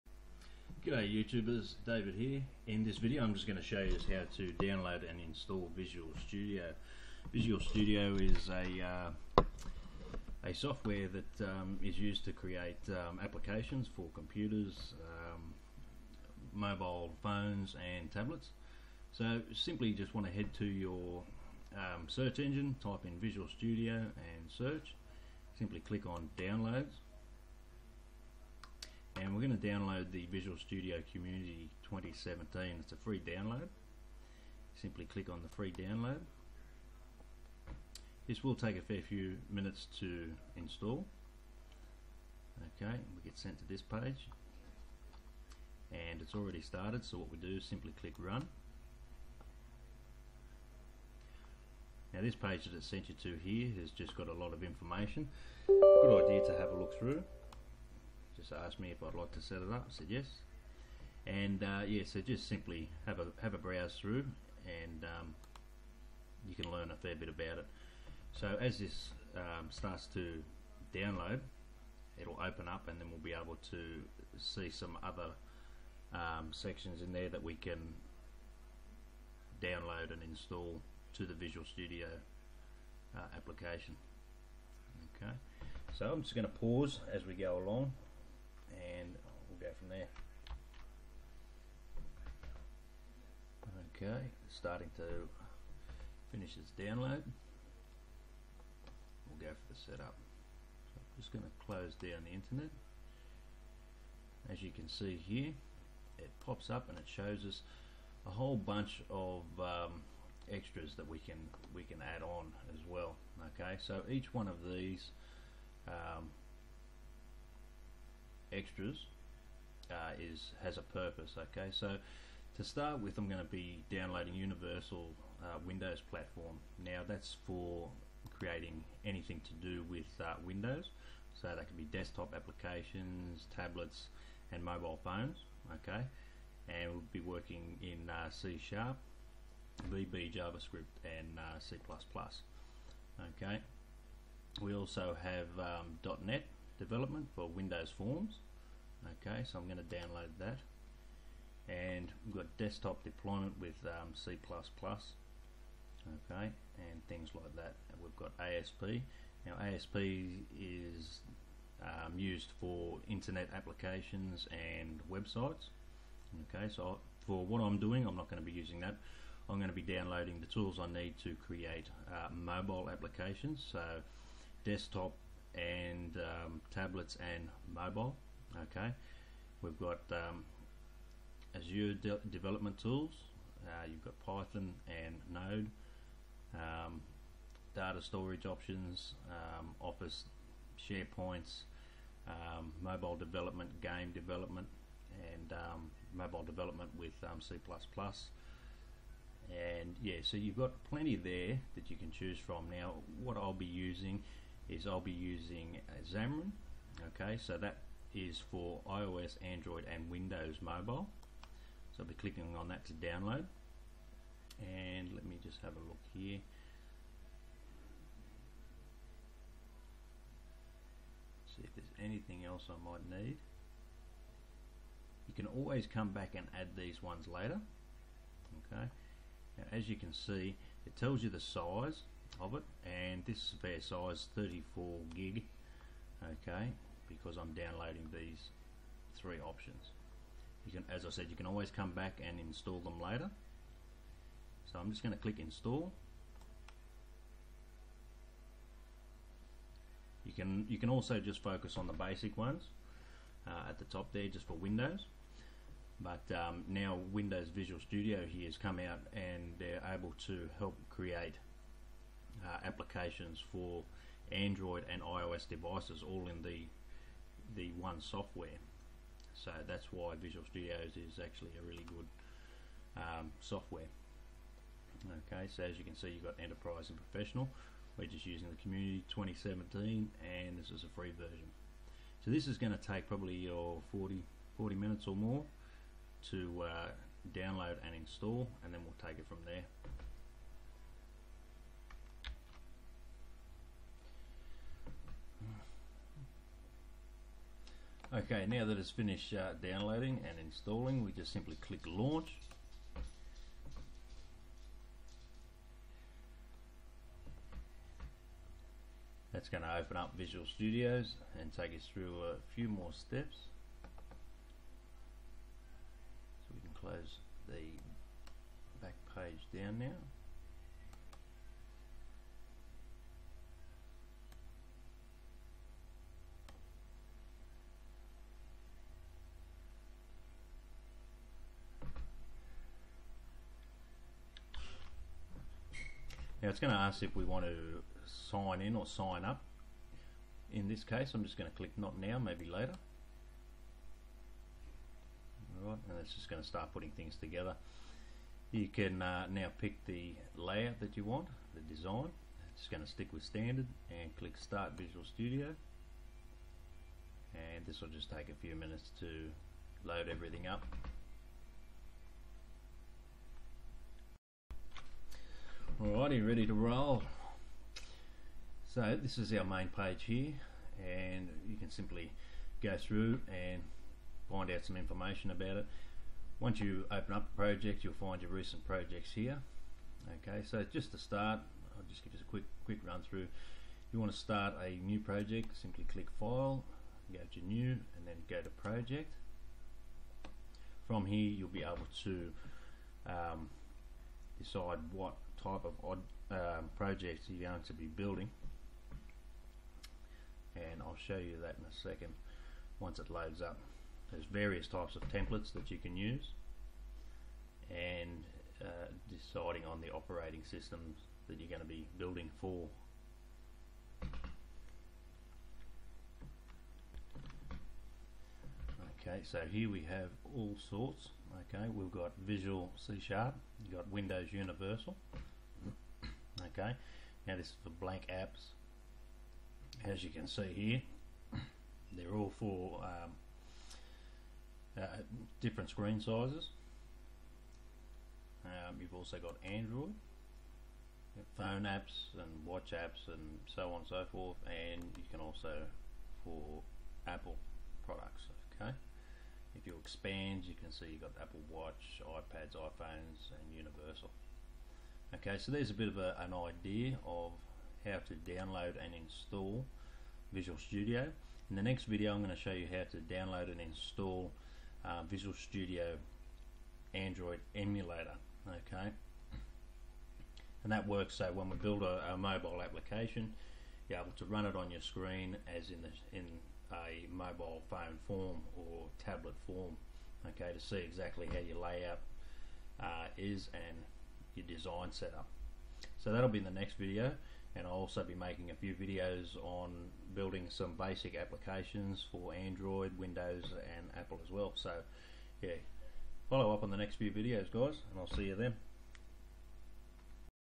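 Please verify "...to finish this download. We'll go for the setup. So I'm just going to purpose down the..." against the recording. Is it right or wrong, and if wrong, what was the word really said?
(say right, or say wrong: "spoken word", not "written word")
wrong: "close", not "purpose".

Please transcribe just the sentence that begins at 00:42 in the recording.
Okay, we get sent to this page and it's already started so what we do is simply click run.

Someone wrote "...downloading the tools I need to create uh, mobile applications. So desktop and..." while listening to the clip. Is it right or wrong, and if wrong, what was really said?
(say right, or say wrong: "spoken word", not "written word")
right.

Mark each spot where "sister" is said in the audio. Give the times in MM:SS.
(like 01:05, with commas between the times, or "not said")
not said.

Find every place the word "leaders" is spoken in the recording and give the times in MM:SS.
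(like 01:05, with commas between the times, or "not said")
not said.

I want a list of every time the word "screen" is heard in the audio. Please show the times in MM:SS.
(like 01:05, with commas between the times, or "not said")
07:15, 07:54.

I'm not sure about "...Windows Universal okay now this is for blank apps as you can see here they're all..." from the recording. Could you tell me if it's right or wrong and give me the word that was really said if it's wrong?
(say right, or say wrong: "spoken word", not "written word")
right.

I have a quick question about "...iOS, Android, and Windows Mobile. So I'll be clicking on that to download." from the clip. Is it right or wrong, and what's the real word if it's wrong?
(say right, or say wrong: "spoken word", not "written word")
right.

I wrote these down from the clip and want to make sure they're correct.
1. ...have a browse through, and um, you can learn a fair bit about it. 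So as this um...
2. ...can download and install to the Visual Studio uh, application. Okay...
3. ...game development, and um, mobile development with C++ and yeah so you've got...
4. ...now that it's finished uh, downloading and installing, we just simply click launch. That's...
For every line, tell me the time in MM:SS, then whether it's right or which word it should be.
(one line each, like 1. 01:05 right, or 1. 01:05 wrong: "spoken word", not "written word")
1. 01:03 right
2. 01:17 right
3. 03:13 right
4. 04:58 right.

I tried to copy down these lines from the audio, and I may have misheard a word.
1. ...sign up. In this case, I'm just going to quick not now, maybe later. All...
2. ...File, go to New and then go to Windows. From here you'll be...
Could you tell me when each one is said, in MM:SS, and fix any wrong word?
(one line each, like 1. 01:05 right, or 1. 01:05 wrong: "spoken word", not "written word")
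1. 05:38 wrong: "click", not "quick"
2. 06:26 wrong: "Project", not "Windows".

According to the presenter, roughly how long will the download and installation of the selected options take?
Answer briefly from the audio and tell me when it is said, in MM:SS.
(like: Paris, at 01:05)
40 minutes, at 04:44.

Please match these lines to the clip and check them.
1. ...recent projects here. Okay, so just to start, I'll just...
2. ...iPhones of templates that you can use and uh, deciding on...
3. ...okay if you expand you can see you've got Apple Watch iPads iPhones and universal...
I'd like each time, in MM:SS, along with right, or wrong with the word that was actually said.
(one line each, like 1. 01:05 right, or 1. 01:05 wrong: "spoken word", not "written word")
1. 06:18 right
2. 06:44 wrong: "types", not "iPhones"
3. 07:28 right.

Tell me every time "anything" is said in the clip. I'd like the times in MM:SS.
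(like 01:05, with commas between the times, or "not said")
02:09, 03:42.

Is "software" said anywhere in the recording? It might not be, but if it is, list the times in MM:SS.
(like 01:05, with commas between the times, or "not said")
00:10, 04:27, 04:33.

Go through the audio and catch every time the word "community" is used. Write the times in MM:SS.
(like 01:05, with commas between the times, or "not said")
00:31, 04:38.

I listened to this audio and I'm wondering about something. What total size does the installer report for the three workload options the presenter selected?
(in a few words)
34 gig.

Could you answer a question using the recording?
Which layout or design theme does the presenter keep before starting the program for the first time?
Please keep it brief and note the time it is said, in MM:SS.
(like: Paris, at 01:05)
standard, at 05:53.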